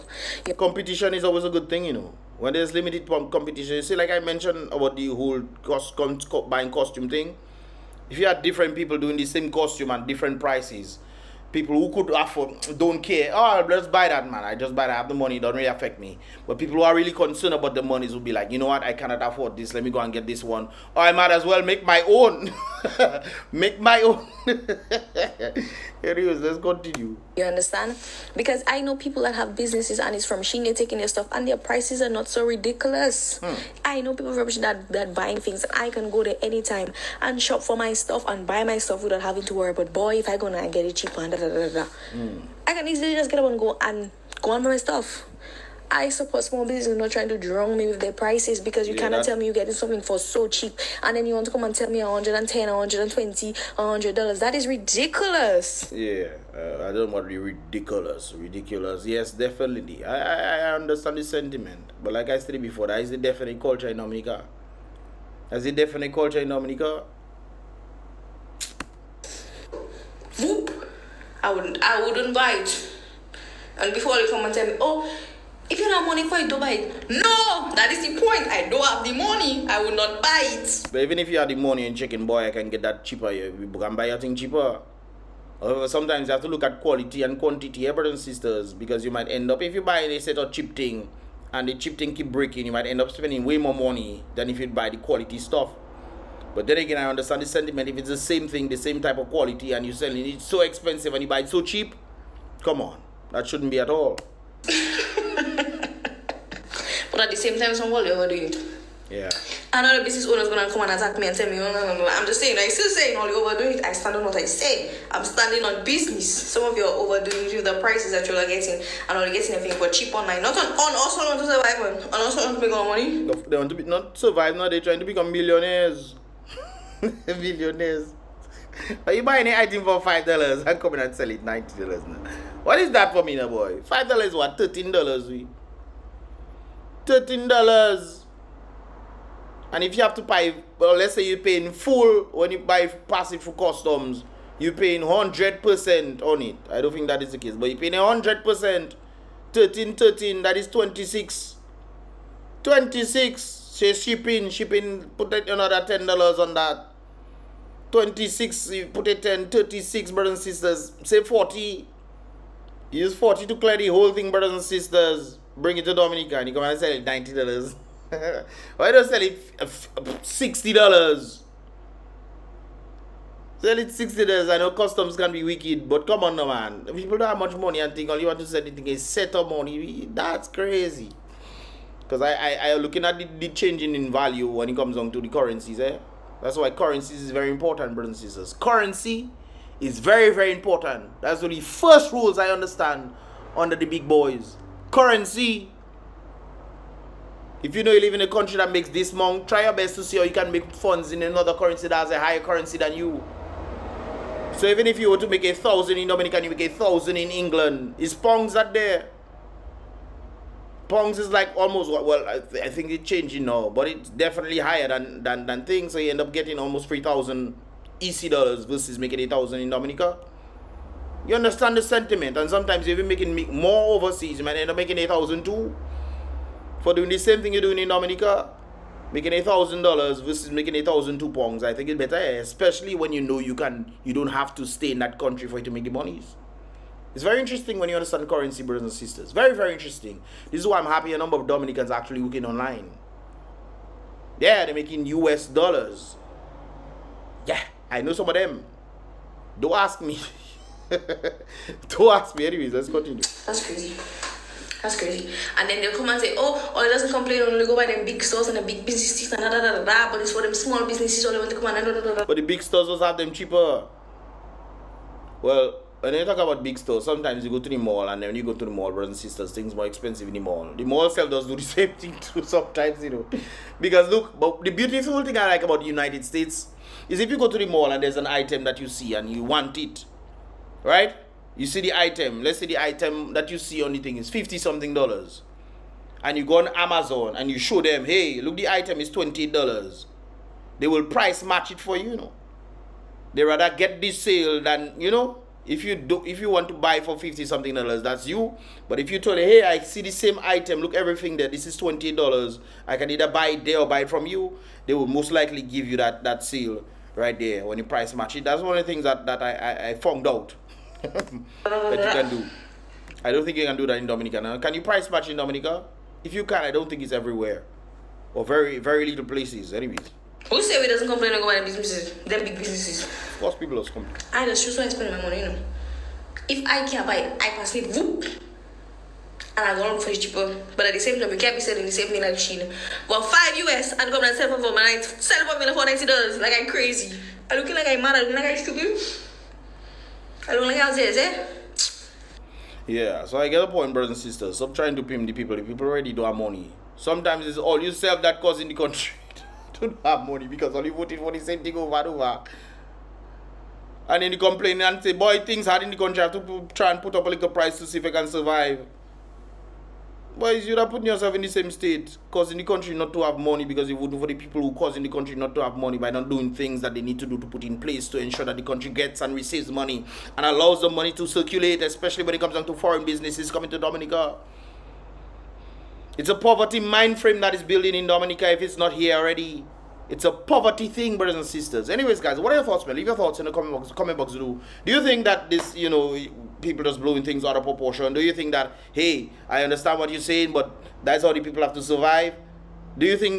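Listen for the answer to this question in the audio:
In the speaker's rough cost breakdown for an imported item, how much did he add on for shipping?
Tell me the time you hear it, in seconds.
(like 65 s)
155 s.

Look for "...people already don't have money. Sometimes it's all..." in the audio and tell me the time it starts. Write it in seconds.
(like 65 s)
345 s.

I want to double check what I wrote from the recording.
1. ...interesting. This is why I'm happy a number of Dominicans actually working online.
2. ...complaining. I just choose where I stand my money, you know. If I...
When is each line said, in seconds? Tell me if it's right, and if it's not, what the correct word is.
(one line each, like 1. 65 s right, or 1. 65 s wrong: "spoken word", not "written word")
1. 239 s right
2. 323 s wrong: "spend", not "stand".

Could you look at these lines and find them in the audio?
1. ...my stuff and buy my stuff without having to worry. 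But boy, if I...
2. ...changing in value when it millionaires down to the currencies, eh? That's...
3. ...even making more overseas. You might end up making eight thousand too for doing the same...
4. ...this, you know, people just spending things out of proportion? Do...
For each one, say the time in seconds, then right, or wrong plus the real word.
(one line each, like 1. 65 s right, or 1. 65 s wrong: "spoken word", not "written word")
1. 37 s right
2. 183 s wrong: "comes", not "millionaires"
3. 222 s right
4. 385 s wrong: "blowing", not "spending".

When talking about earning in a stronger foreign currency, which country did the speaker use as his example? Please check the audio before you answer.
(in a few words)
England.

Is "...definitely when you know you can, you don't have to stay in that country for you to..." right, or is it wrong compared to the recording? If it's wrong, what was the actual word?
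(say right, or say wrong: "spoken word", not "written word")
wrong: "especially", not "definitely".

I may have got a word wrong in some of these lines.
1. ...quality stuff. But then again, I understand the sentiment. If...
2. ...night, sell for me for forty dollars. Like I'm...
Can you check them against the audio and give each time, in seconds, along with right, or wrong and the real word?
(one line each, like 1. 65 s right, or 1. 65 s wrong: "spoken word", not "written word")
1. 94 s right
2. 334 s wrong: "ninety", not "forty".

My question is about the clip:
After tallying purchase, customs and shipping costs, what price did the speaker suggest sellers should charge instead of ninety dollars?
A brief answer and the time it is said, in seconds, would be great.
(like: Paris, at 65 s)
$60, at 173 s.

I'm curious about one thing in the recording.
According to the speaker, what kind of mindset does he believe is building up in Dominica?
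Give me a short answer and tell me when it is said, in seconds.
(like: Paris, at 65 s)
Poverty mind frame, at 376 s.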